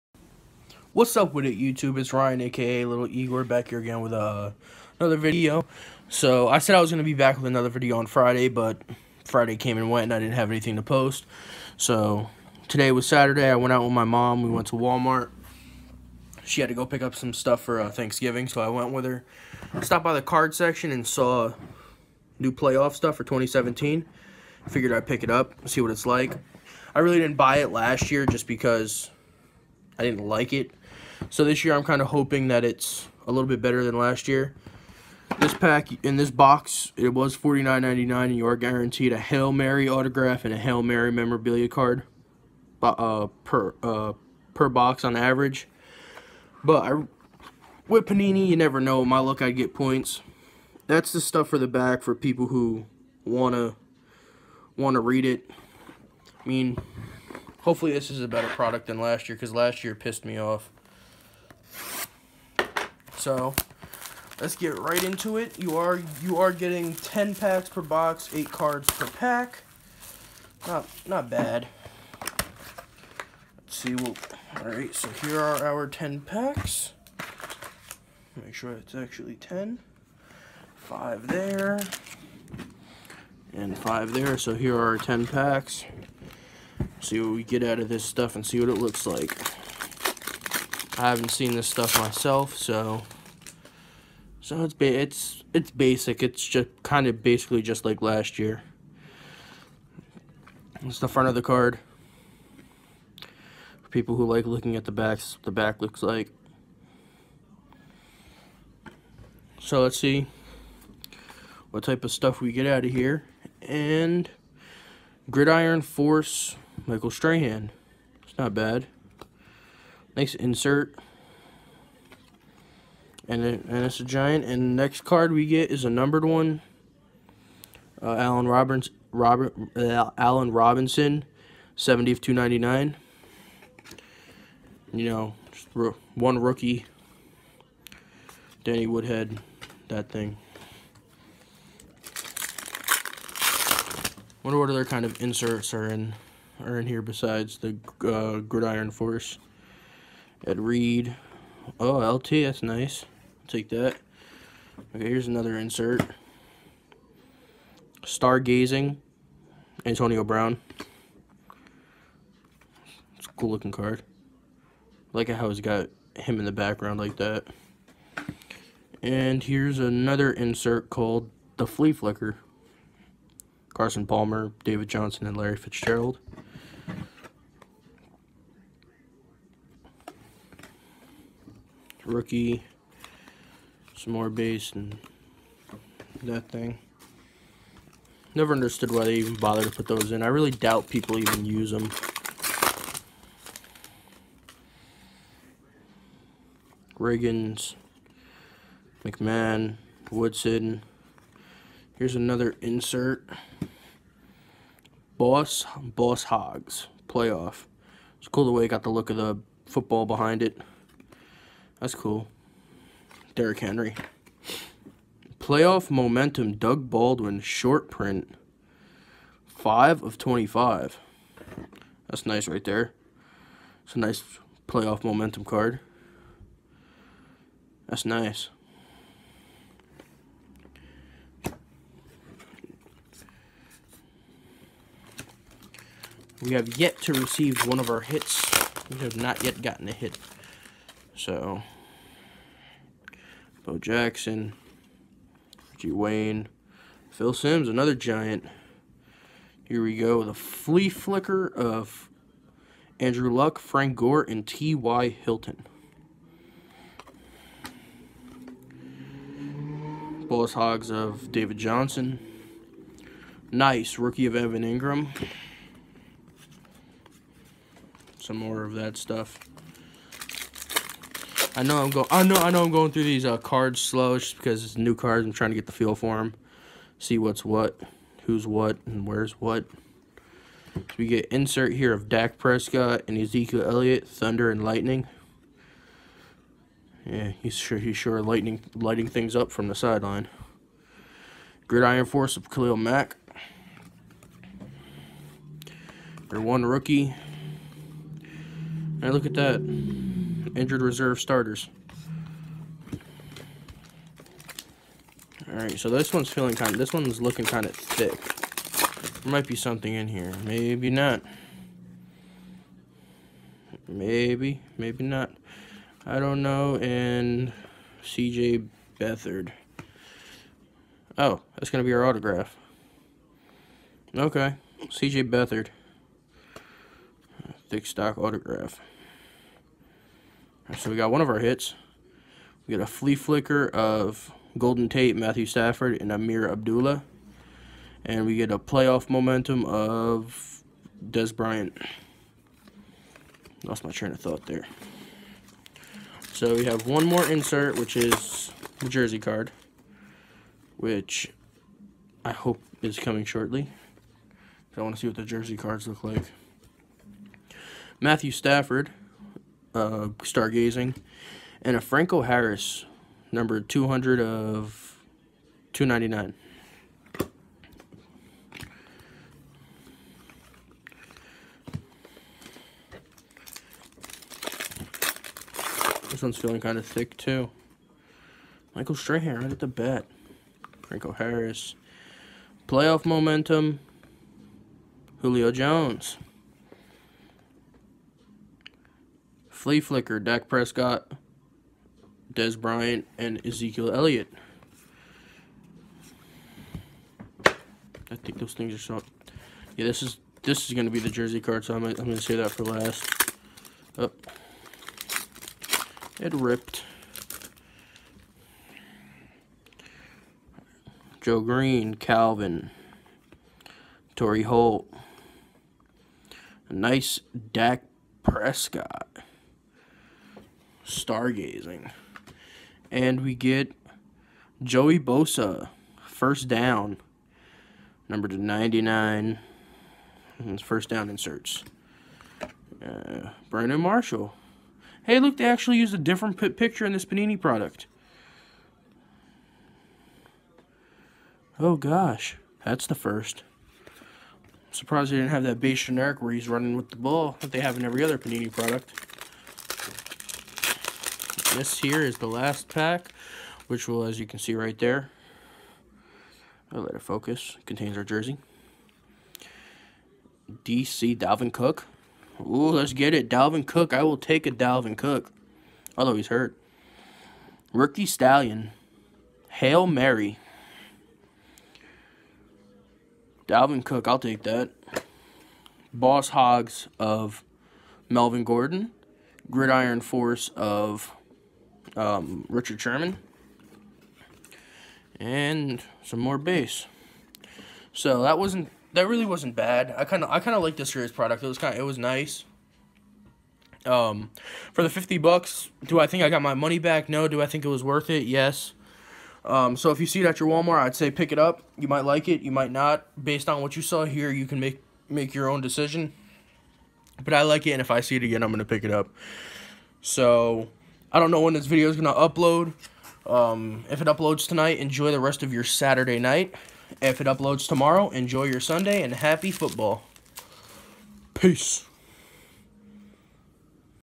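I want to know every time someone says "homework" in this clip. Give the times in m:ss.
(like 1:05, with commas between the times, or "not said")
not said.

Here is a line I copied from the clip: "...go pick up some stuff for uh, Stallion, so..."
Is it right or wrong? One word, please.
wrong.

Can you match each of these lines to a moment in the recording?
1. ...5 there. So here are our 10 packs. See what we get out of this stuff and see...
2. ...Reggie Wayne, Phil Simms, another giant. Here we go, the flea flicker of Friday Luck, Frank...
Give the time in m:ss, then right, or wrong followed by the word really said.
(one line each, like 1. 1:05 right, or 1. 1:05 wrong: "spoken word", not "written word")
1. 1:23 right
2. 4:05 wrong: "Andrew", not "Friday".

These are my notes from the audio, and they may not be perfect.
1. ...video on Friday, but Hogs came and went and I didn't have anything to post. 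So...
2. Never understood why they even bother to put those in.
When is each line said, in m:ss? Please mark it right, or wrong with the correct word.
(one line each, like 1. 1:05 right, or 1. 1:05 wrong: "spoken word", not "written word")
1. 0:07 wrong: "Friday", not "Hogs"
2. 3:08 right.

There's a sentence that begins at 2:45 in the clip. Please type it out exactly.
I like how he's got him in the background like that.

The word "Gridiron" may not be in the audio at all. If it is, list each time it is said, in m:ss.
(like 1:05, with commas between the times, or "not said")
1:55, 2:28, 4:51, 7:59.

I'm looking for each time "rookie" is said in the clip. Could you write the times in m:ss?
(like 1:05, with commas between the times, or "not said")
2:16, 3:02, 4:23, 4:56, 7:47.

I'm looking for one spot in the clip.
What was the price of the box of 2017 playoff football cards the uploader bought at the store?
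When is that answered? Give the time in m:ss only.
0:37.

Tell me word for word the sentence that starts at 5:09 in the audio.
There might be something in here.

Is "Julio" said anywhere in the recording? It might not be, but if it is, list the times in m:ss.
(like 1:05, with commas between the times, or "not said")
6:25.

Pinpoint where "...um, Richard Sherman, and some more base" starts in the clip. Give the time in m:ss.
8:01.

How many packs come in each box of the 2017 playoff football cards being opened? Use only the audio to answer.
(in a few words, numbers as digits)
10.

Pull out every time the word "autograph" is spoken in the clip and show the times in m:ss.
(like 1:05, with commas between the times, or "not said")
0:39, 5:22, 5:28.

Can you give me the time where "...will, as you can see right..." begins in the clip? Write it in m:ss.
7:33.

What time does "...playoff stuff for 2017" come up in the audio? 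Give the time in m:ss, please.
0:22.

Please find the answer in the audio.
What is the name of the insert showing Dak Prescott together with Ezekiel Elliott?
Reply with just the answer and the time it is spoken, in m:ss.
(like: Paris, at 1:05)
Thunder and Lightning, at 4:44.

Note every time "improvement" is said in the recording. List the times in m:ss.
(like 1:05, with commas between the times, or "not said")
not said.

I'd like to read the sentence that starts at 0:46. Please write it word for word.
But I, with Panini, you never know.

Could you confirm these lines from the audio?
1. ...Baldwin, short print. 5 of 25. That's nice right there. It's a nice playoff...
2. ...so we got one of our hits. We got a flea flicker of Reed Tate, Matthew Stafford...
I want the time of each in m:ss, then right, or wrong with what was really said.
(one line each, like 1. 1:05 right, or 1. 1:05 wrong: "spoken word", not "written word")
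1. 3:36 right
2. 5:30 wrong: "Golden", not "Reed".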